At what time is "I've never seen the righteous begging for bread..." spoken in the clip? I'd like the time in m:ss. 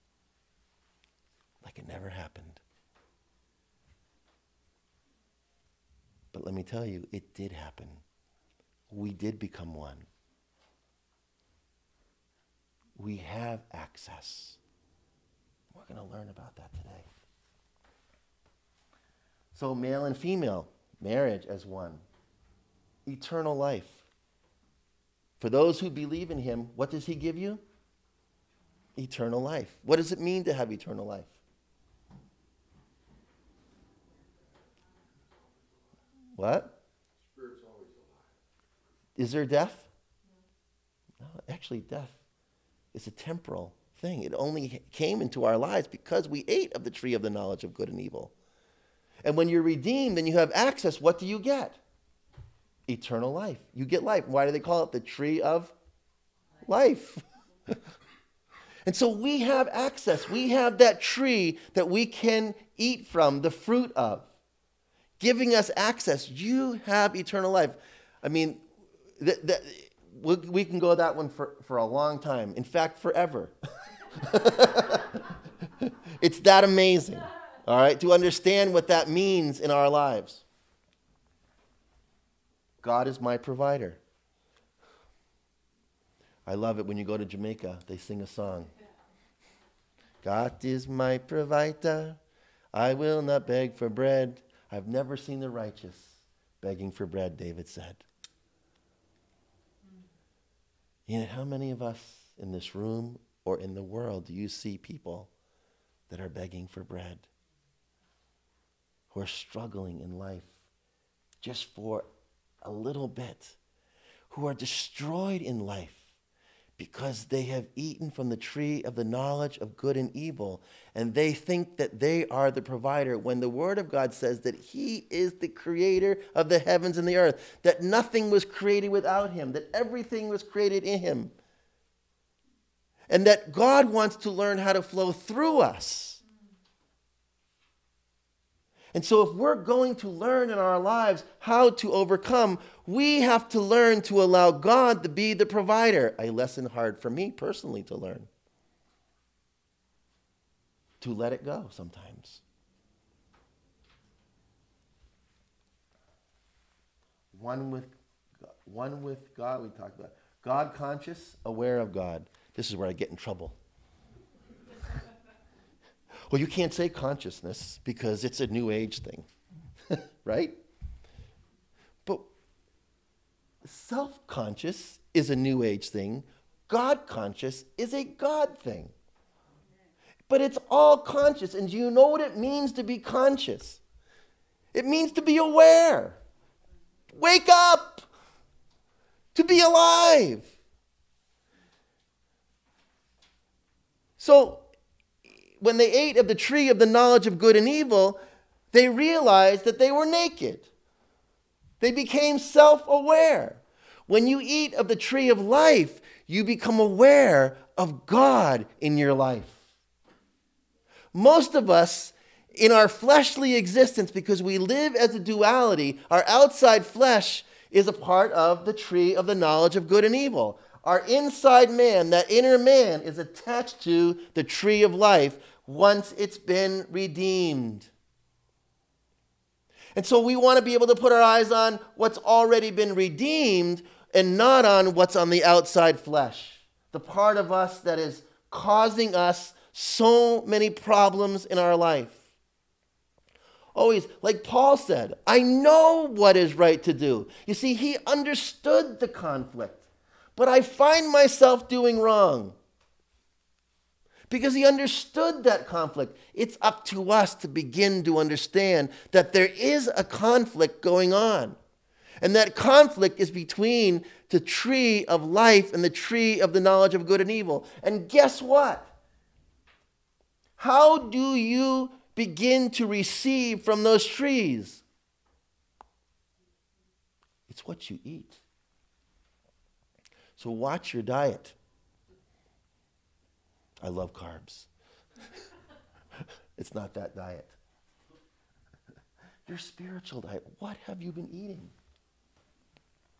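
1:34.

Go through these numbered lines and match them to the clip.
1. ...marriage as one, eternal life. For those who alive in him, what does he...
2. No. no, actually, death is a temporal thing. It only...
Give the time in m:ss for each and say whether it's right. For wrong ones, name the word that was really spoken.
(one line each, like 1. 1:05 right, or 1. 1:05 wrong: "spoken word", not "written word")
1. 0:21 wrong: "believe", not "alive"
2. 0:41 right.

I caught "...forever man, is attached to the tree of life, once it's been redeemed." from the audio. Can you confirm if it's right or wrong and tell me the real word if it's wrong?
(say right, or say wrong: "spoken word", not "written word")
wrong: "inner", not "forever".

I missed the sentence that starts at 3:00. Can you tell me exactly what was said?
But it's all conscious, and do you know what it means to be conscious?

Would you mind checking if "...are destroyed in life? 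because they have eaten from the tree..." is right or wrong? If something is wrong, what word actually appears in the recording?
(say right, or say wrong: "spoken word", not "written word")
right.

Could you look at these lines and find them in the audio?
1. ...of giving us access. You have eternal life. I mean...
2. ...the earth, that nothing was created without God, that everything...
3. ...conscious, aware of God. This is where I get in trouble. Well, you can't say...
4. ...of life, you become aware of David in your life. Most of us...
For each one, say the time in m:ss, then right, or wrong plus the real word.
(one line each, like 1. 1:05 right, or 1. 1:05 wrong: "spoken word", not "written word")
1. 1:03 right
2. 2:07 wrong: "Him", not "God"
3. 2:40 right
4. 3:25 wrong: "God", not "David".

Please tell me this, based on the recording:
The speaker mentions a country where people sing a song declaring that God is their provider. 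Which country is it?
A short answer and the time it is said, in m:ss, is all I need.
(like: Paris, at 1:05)
Jamaica, at 1:27.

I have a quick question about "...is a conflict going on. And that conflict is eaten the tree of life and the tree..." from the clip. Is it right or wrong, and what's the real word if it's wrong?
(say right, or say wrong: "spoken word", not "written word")
wrong: "between", not "eaten".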